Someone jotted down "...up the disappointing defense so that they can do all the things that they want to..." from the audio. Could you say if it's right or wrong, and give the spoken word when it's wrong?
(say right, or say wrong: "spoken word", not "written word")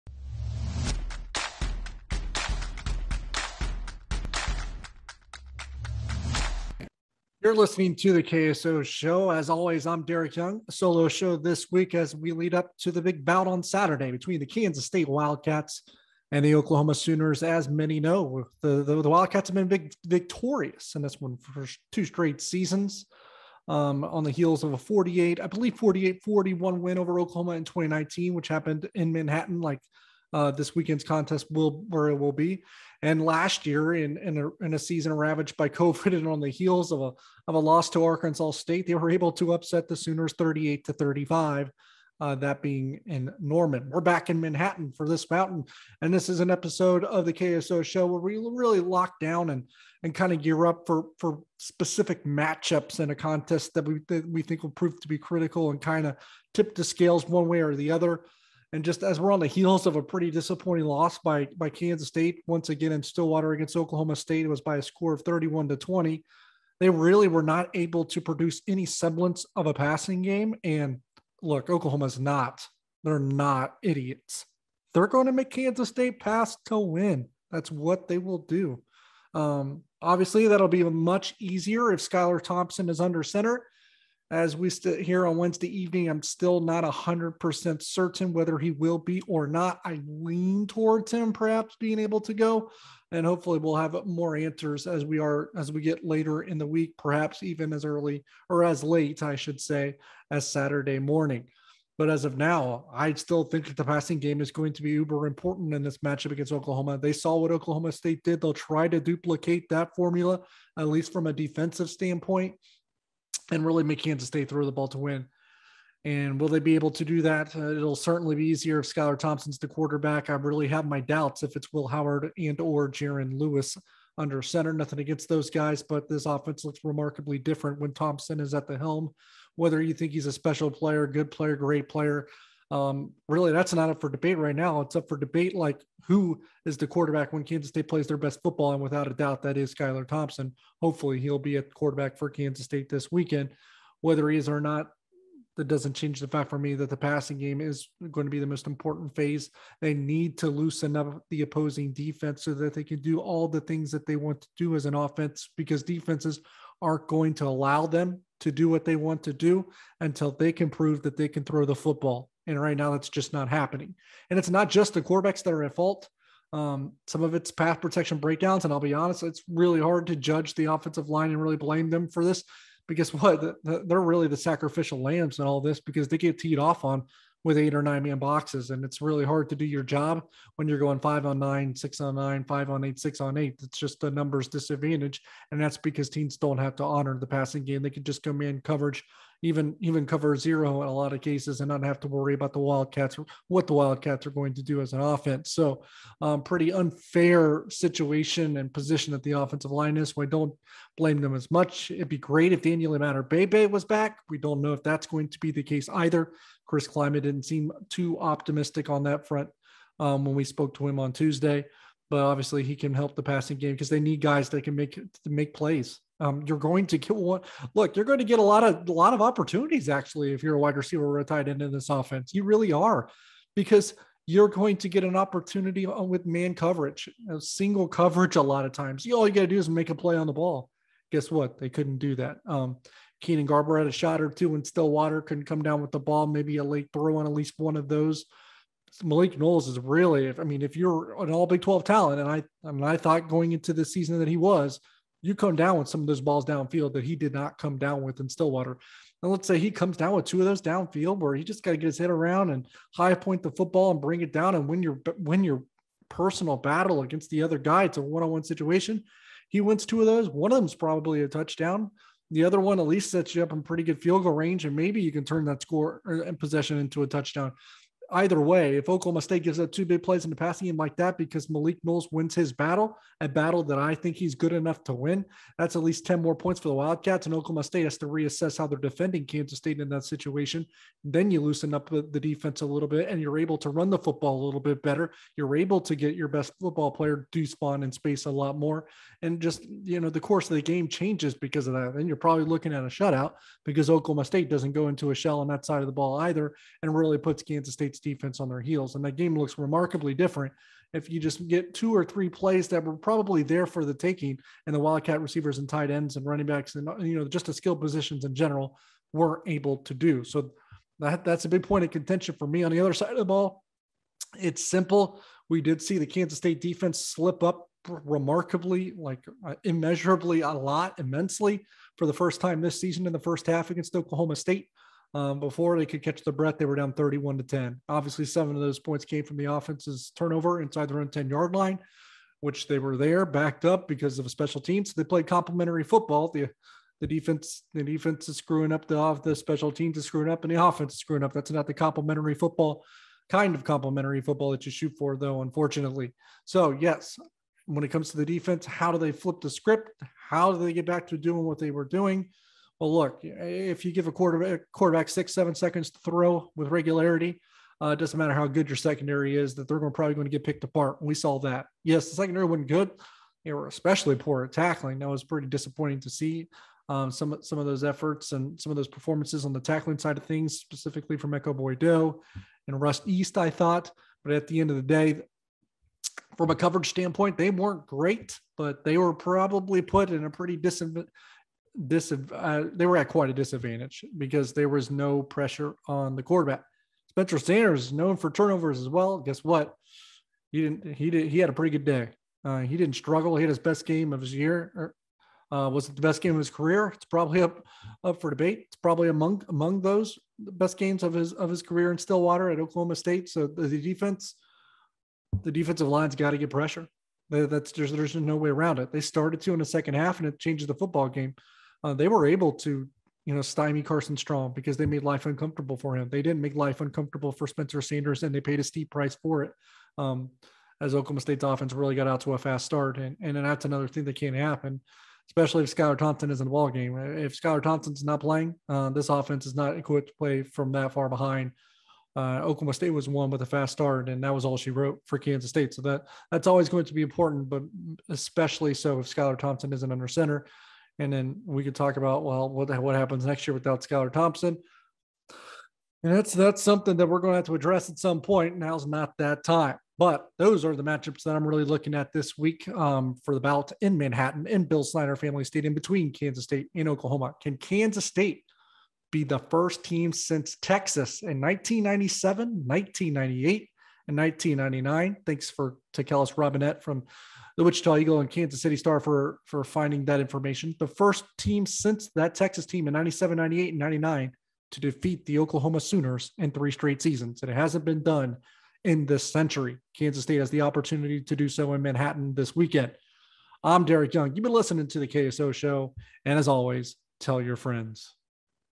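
wrong: "opposing", not "disappointing".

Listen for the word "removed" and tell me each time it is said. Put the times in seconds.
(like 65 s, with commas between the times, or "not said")
not said.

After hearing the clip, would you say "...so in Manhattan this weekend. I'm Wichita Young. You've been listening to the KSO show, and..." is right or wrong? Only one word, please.
wrong.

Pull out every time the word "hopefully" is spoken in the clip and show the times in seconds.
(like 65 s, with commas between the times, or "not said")
93 s, 140 s.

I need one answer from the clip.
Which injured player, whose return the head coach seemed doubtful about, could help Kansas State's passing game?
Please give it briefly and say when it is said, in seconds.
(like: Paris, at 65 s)
Daniel Imatorbhebhe, at 202 s.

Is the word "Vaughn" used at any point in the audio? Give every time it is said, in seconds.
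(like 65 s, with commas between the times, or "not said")
287 s.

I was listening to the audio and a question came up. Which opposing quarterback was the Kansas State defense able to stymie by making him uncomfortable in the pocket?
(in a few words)
Carson Strong.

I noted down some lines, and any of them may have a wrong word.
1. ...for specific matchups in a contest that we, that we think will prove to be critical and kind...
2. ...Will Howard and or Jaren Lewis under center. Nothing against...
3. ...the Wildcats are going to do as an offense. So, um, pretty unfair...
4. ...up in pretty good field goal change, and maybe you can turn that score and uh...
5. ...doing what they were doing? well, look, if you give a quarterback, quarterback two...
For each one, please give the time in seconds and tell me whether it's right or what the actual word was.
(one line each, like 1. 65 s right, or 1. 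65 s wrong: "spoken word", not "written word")
1. 51 s right
2. 121 s right
3. 193 s right
4. 263 s wrong: "range", not "change"
5. 351 s wrong: "six", not "two".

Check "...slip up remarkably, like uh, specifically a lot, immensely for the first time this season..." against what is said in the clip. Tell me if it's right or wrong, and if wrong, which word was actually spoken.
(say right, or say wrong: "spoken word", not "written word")
wrong: "immeasurably", not "specifically".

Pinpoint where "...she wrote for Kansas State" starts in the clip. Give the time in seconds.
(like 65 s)
434 s.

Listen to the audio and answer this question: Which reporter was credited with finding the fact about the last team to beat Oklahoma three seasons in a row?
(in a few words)
Kellis Robinett.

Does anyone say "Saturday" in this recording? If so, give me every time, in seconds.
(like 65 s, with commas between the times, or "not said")
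13 s, 100 s.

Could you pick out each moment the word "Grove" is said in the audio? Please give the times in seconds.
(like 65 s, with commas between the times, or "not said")
not said.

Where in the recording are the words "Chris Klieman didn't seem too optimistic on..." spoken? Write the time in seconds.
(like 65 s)
206 s.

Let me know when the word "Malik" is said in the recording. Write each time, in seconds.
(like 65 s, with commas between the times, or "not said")
239 s, 271 s.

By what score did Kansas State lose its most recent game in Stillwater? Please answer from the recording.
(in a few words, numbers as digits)
31 to 20.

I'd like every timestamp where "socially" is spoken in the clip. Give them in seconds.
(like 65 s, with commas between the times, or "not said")
not said.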